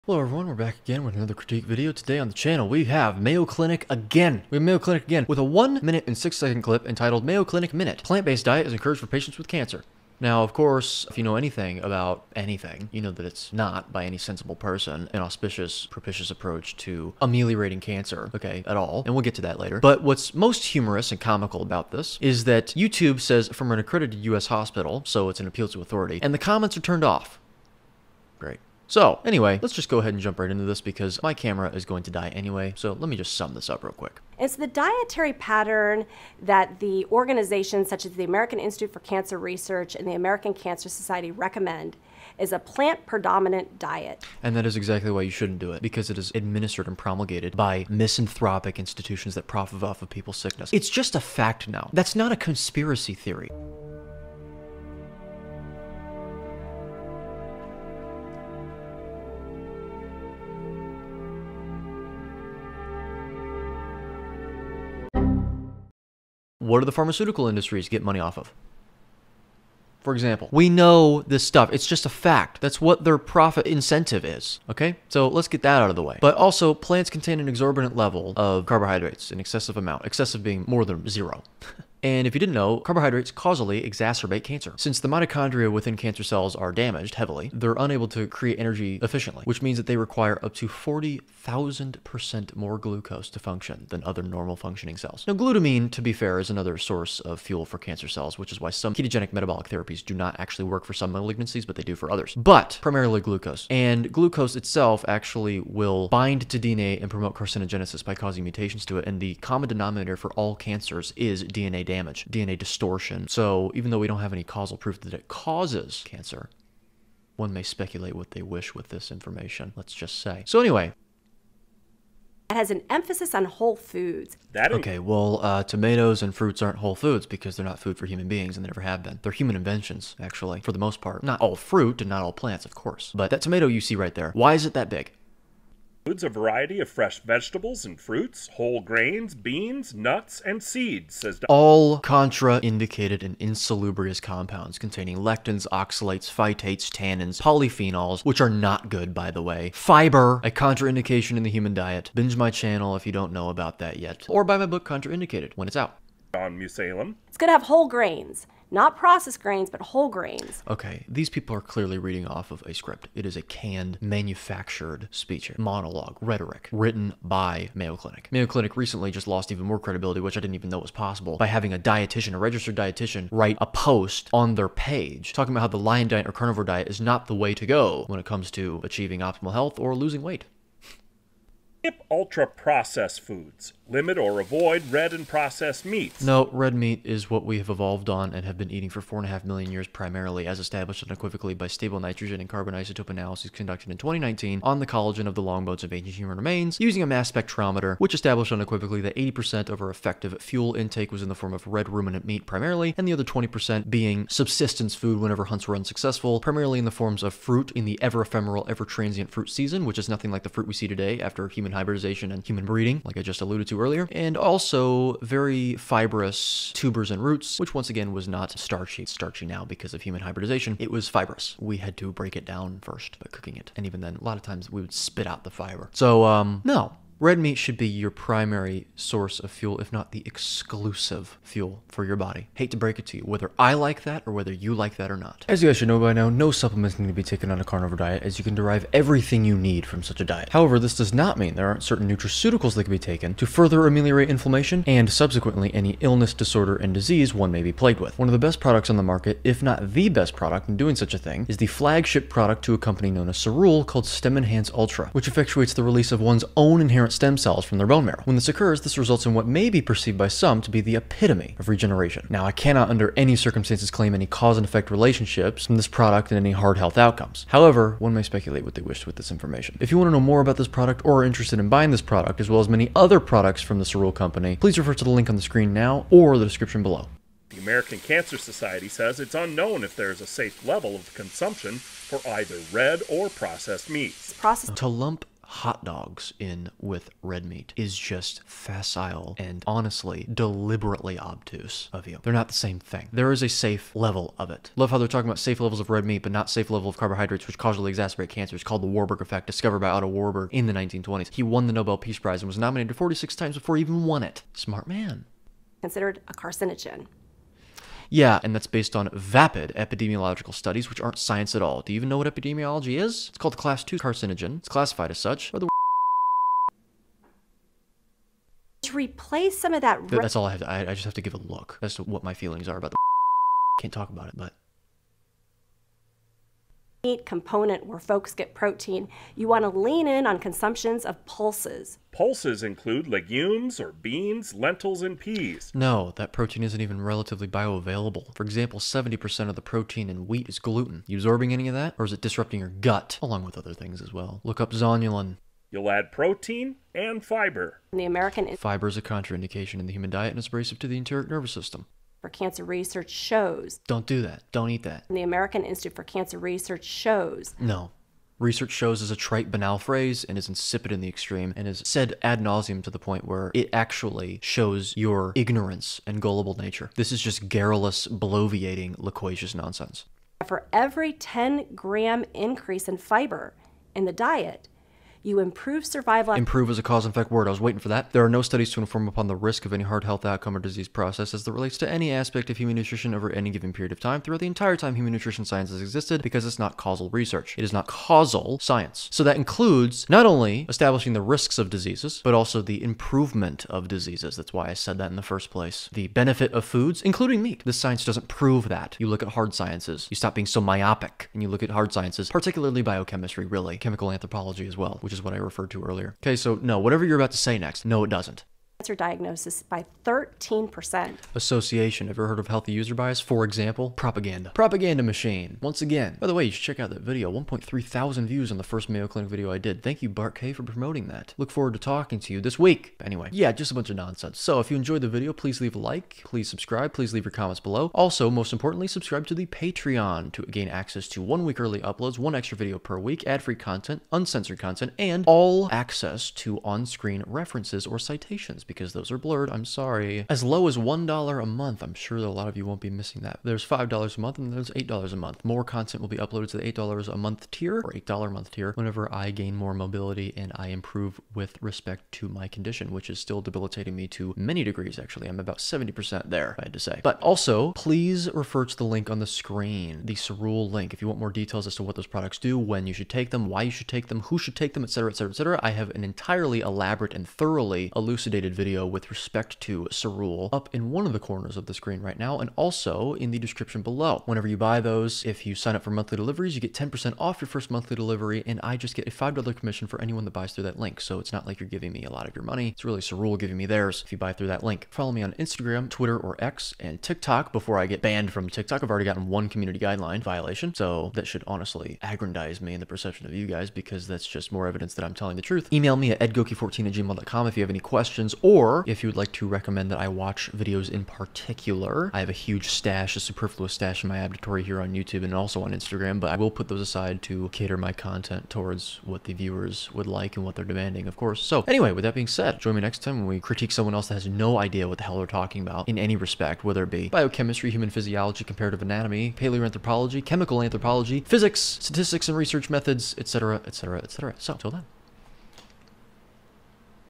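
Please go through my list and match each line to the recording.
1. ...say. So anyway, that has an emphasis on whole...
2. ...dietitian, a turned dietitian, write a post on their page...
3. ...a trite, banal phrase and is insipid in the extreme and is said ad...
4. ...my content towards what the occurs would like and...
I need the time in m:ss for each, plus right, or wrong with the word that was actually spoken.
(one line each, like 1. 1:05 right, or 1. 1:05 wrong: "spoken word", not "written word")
1. 2:00 right
2. 2:51 wrong: "registered", not "turned"
3. 5:59 right
4. 8:27 wrong: "viewers", not "occurs".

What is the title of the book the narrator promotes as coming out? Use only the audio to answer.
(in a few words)
Contraindicated.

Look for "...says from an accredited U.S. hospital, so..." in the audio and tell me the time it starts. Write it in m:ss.
0:23.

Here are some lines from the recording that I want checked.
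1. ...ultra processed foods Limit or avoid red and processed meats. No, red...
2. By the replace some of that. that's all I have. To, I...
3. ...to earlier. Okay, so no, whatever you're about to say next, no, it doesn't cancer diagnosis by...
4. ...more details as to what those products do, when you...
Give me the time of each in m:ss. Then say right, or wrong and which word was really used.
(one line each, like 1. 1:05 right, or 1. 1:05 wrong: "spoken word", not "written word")
1. 3:02 right
2. 5:15 right
3. 6:45 right
4. 7:41 right.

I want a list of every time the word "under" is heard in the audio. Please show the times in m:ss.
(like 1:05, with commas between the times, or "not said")
4:22.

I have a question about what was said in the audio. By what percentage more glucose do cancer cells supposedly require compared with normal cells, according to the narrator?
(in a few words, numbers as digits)
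40,000%.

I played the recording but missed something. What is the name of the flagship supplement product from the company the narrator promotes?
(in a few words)
Stem Enhance Ultra.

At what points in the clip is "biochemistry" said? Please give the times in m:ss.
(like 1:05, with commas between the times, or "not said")
6:42, 8:37.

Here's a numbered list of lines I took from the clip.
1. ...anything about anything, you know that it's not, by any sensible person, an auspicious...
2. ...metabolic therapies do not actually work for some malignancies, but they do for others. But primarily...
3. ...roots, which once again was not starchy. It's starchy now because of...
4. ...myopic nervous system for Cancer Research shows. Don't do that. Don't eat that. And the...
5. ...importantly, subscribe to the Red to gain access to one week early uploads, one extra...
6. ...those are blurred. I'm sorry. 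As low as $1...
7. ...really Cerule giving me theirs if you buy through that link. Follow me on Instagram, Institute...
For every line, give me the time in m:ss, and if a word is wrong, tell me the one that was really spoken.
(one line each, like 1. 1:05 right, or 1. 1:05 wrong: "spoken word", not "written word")
1. 0:11 right
2. 1:39 right
3. 3:37 right
4. 5:50 wrong: "enteric", not "myopic"
5. 7:08 wrong: "Patreon", not "Red"
6. 7:18 right
7. 8:02 wrong: "Twitter", not "Institute".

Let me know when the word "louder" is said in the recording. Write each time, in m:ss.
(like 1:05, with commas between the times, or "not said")
not said.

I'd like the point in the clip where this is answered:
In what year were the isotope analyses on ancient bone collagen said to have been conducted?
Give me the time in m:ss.
3:13.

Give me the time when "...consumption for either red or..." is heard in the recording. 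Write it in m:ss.
4:41.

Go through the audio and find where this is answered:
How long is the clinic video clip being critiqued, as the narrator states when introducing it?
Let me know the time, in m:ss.
0:05.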